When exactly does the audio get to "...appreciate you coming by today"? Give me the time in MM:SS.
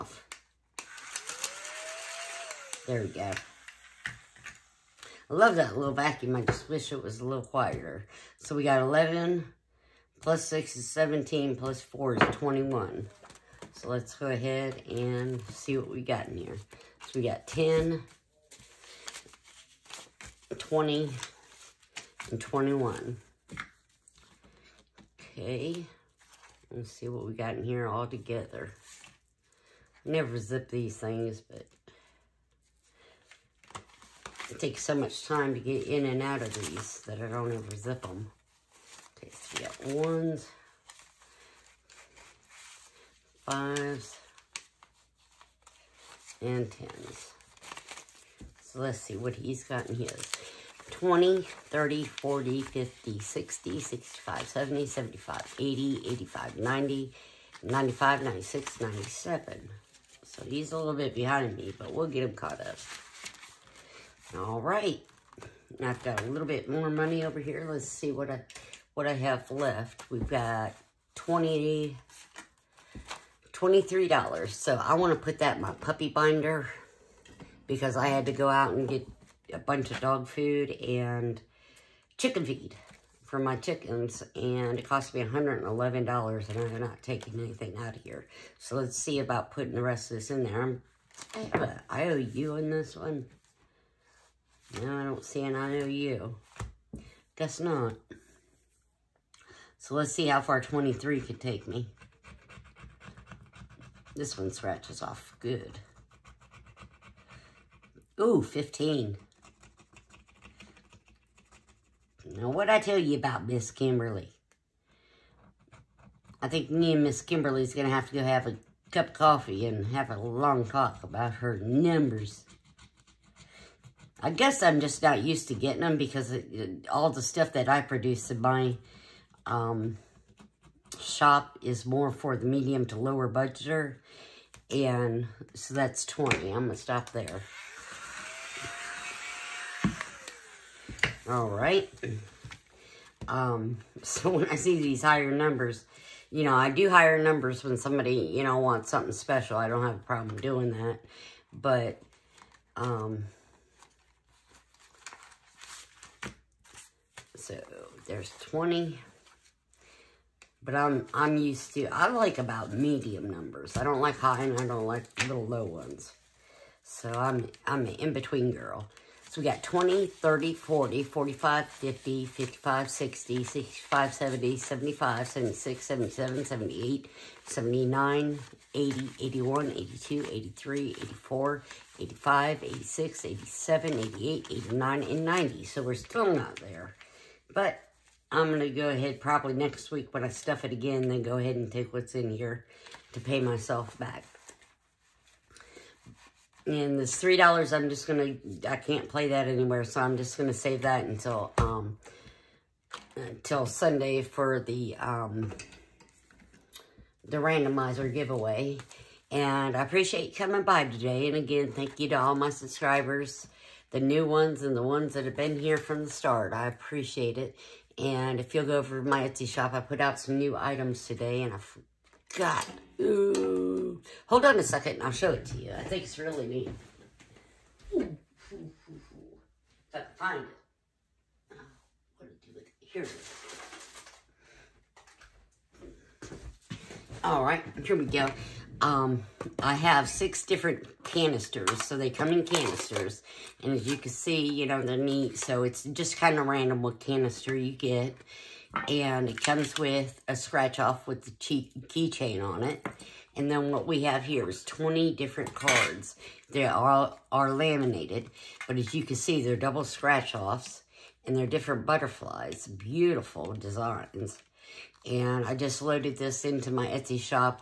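03:29.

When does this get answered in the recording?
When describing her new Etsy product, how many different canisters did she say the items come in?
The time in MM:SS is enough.
04:00.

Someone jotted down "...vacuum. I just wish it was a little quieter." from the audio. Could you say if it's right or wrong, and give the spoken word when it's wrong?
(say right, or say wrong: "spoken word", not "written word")
right.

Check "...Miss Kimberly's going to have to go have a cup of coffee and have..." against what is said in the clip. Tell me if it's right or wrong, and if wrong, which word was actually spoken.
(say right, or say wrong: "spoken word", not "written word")
right.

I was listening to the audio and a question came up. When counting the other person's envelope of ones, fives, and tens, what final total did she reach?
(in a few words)
97.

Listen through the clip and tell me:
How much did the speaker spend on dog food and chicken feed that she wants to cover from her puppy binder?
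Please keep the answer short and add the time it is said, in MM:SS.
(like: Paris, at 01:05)
$111, at 01:25.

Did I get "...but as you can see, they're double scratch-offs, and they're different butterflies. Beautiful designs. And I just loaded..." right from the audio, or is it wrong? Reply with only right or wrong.
right.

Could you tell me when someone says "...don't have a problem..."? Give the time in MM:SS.
02:29.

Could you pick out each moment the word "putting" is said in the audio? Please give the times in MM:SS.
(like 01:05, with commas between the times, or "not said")
01:29.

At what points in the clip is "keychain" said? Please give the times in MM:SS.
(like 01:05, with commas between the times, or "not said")
04:11.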